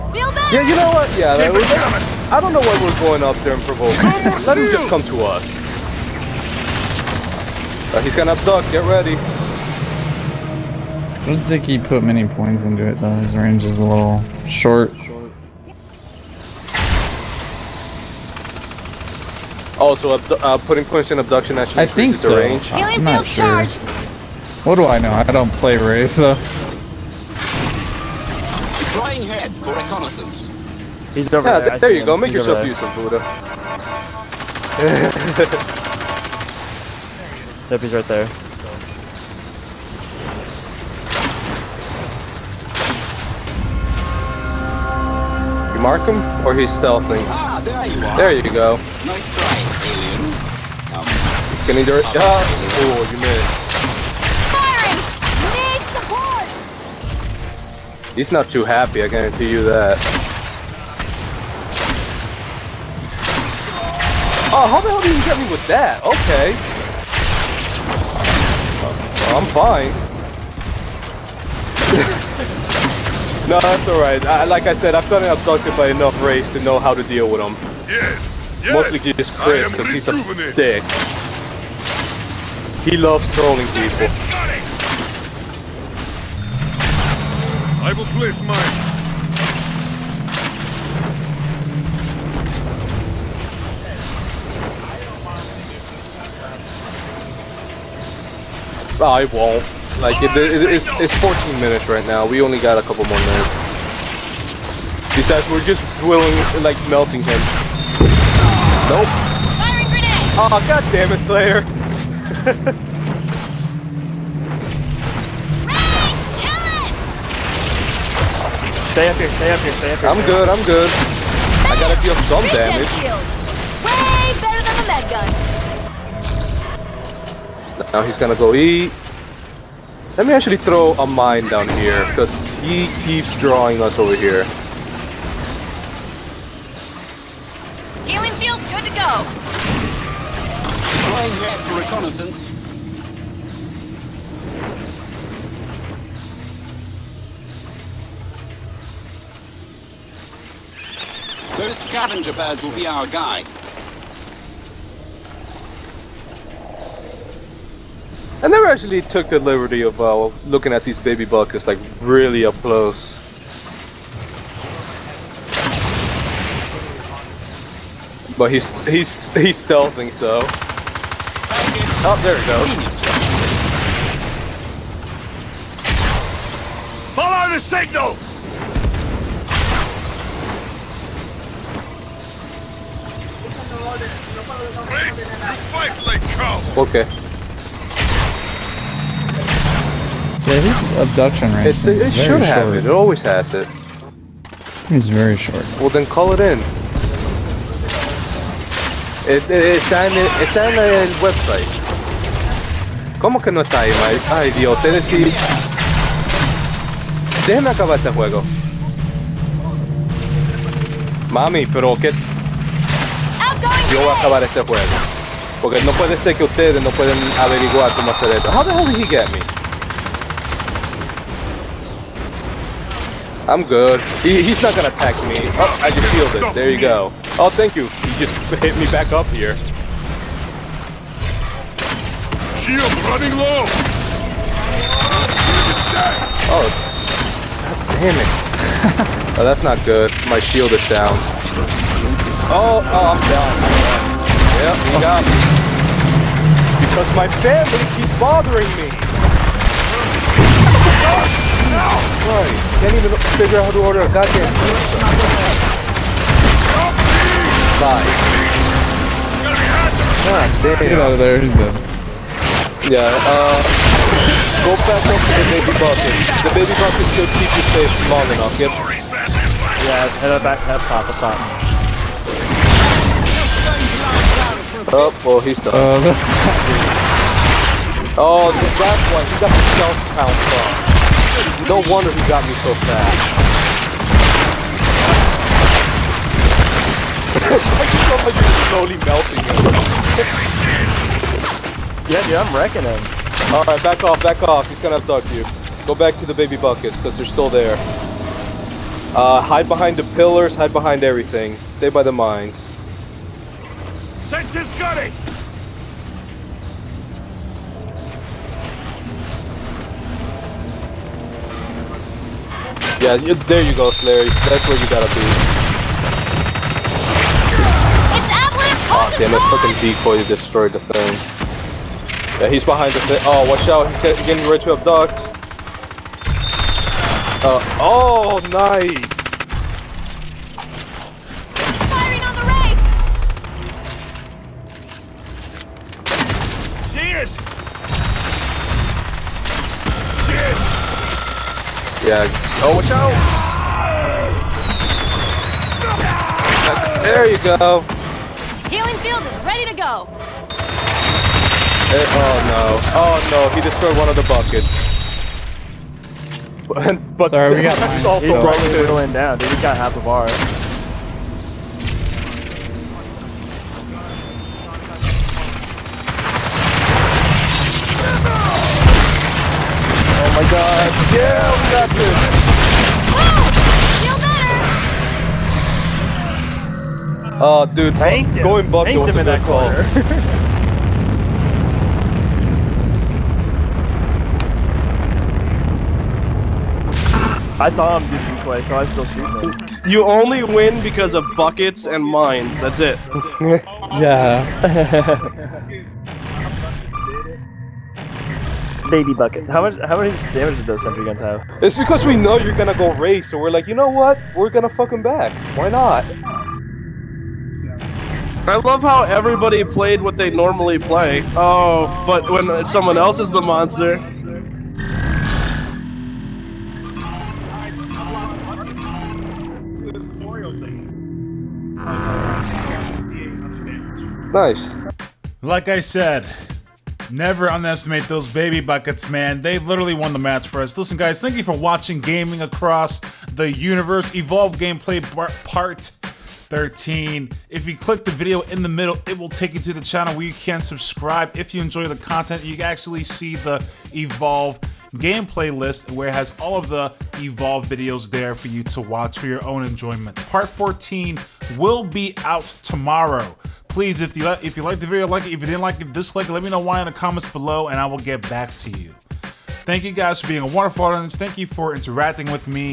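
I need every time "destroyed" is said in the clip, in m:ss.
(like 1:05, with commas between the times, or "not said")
5:20, 5:53.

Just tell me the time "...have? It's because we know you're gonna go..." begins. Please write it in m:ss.
6:41.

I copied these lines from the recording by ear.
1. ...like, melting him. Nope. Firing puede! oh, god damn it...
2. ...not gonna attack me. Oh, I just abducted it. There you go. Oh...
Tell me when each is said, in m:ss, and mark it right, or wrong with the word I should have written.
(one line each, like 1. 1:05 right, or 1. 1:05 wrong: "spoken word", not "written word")
1. 1:46 wrong: "grenade", not "puede"
2. 3:44 wrong: "healed", not "abducted".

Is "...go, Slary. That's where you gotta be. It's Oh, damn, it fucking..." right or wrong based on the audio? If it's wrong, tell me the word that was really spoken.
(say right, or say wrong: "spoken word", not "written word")
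right.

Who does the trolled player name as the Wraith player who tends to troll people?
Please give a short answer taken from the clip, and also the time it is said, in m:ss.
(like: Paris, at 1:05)
Chris, at 1:19.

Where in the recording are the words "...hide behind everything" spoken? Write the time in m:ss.
5:00.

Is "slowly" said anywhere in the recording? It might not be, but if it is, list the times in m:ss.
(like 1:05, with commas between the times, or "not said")
4:48.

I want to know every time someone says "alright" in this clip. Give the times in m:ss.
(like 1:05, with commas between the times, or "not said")
1:13, 4:53.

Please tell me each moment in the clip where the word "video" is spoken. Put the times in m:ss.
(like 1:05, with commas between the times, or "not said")
7:18, 7:27, 7:34.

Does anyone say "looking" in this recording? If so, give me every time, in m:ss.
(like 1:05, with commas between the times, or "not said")
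2:40.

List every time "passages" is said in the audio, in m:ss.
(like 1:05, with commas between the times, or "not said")
not said.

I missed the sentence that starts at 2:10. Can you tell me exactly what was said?
Let me actually throw a mine down here, because he keeps drawing us over here.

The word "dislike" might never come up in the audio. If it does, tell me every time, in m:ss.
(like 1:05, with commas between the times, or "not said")
7:35.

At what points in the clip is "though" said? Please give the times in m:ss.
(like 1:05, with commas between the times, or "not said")
0:12, 0:26.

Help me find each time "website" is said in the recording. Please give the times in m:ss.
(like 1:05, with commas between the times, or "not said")
3:21.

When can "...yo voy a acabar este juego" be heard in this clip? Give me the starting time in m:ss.
3:33.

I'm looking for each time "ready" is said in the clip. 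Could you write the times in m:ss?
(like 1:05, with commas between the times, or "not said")
0:08, 5:24, 5:49.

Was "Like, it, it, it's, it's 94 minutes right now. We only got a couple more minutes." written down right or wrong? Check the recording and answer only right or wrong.
wrong.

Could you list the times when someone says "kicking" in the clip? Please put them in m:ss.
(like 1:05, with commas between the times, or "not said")
not said.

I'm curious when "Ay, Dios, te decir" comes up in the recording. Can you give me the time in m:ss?
3:24.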